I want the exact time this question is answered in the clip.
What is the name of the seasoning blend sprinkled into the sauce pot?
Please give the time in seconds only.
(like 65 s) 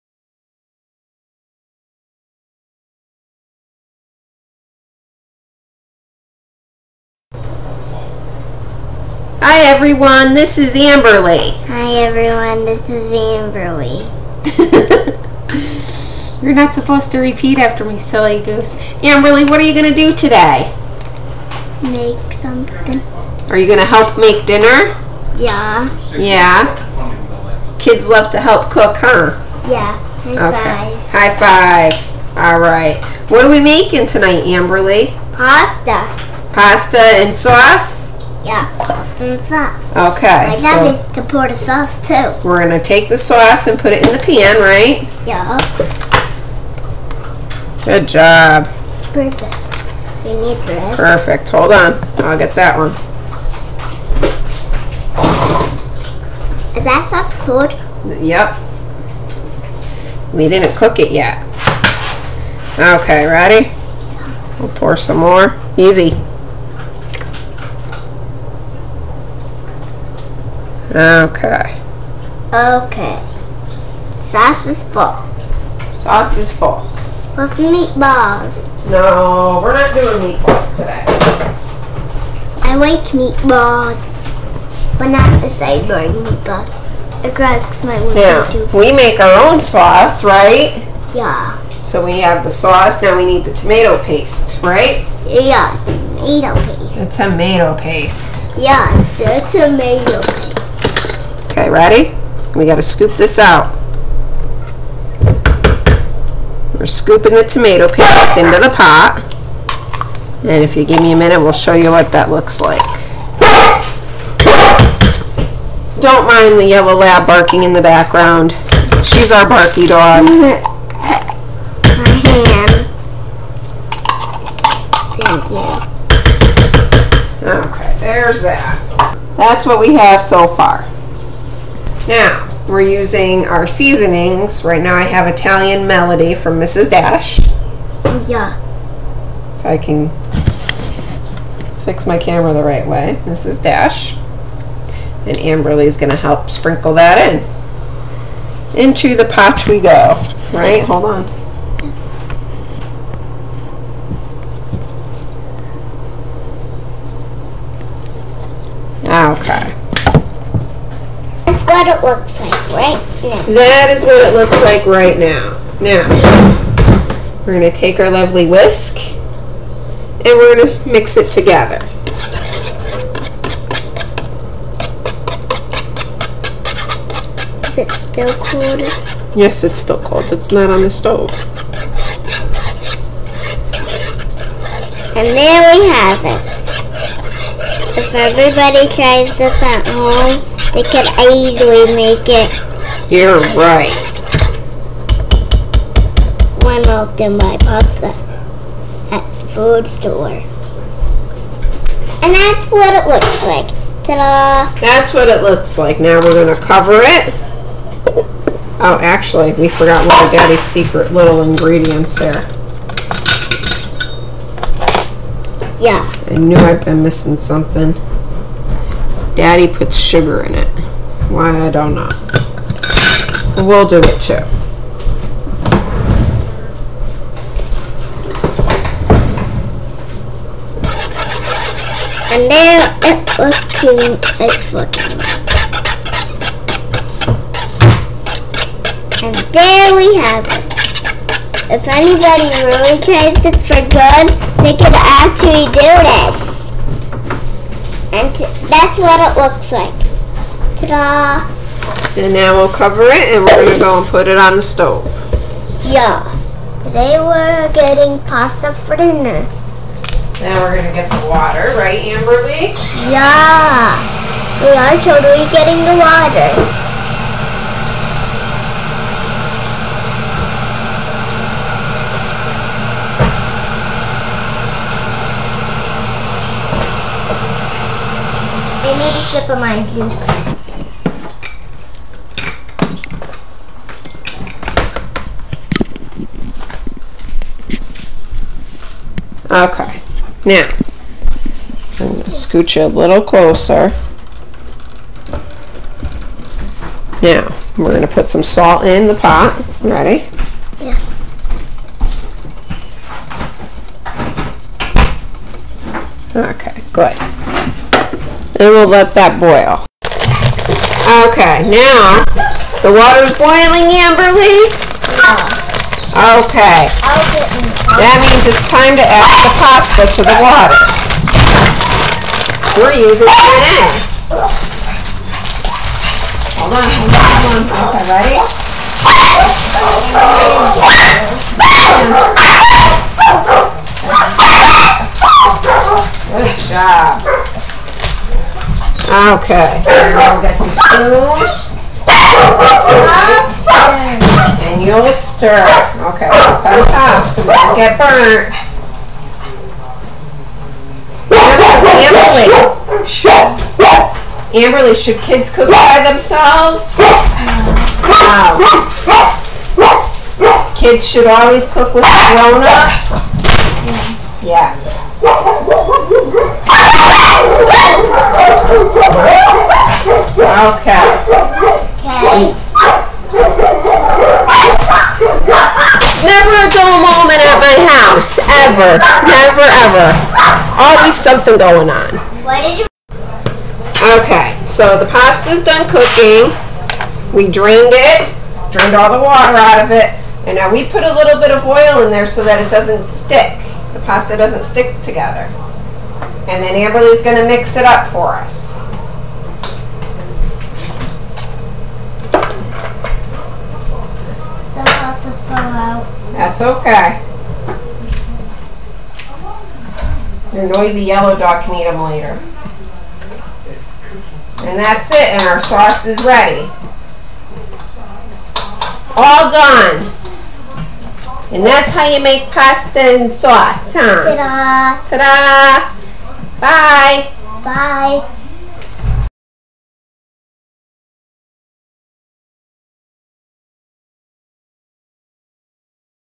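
135 s.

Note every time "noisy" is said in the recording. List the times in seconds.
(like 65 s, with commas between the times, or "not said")
410 s.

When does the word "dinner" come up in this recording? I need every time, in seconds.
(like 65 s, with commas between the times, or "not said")
24 s, 258 s.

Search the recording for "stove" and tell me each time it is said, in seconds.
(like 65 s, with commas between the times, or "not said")
180 s, 254 s.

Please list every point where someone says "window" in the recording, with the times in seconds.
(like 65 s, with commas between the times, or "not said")
88 s.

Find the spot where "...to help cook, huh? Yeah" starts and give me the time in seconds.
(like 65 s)
28 s.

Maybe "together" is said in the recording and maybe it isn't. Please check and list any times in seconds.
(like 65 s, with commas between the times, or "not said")
171 s, 395 s.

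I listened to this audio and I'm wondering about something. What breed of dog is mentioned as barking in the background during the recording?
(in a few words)
Yellow lab.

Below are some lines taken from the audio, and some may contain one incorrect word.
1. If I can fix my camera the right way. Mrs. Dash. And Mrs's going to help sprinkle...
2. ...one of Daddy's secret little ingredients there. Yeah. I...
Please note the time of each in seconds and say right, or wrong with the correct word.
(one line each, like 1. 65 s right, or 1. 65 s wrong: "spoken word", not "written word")
1. 139 s wrong: "Amberly", not "Mrs"
2. 210 s right.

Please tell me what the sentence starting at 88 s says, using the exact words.
We make our own sauce, right?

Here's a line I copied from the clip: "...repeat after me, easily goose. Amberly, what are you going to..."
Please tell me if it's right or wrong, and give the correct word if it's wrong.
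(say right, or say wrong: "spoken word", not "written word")
wrong: "silly", not "easily".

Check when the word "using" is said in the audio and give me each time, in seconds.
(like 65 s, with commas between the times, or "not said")
132 s, 323 s.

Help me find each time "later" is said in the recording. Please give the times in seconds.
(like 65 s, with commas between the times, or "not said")
412 s.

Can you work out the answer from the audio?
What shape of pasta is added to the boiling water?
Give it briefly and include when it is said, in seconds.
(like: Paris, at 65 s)
Penne, at 323 s.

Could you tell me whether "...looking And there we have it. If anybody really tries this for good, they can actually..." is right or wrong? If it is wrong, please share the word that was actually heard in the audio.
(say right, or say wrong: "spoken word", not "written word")
right.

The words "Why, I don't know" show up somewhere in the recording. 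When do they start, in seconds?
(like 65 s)
221 s.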